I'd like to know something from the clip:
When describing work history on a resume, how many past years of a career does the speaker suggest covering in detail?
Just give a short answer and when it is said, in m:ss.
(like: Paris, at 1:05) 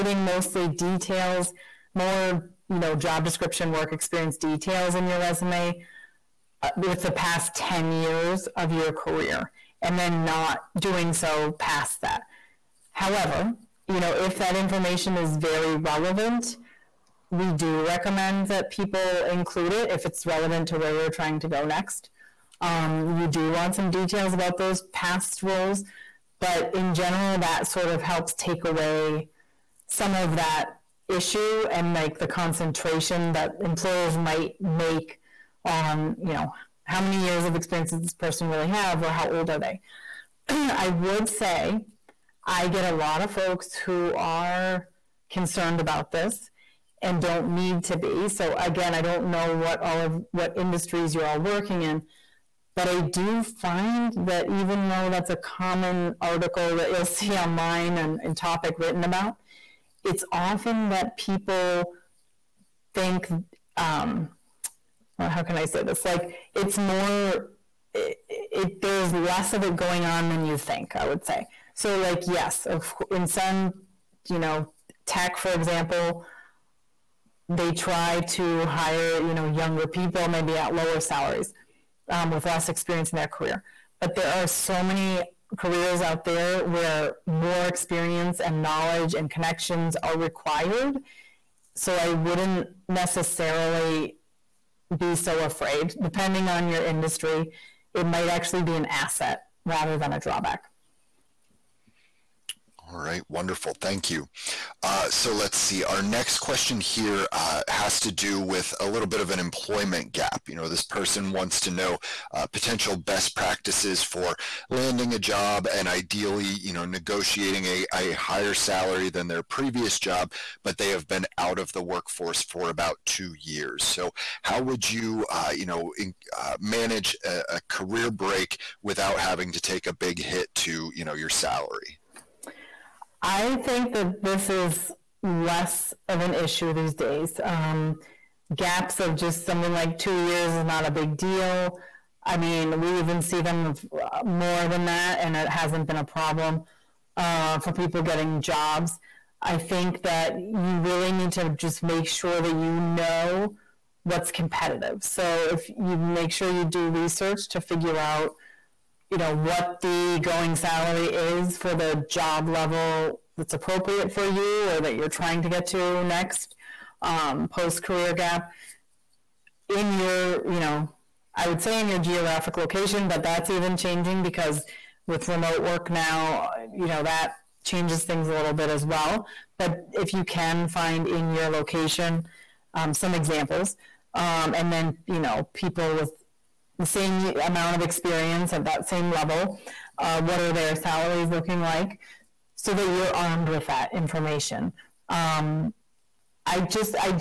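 10 years, at 0:07.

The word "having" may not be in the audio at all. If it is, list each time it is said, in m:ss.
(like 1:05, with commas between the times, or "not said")
2:09.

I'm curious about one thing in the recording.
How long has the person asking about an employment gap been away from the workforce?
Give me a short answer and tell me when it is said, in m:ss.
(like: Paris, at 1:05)
2 years, at 2:02.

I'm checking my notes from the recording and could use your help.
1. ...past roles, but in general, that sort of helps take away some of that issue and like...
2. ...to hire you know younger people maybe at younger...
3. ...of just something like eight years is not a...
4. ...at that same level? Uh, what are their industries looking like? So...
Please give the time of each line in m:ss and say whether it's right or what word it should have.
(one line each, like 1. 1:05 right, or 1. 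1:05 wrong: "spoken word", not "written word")
1. 0:24 right
2. 1:18 wrong: "lower", not "younger"
3. 2:18 wrong: "two", not "eight"
4. 3:08 wrong: "salaries", not "industries".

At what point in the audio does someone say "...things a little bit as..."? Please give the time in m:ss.
2:58.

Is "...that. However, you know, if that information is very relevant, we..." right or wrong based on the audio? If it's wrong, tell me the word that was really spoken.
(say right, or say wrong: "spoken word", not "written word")
right.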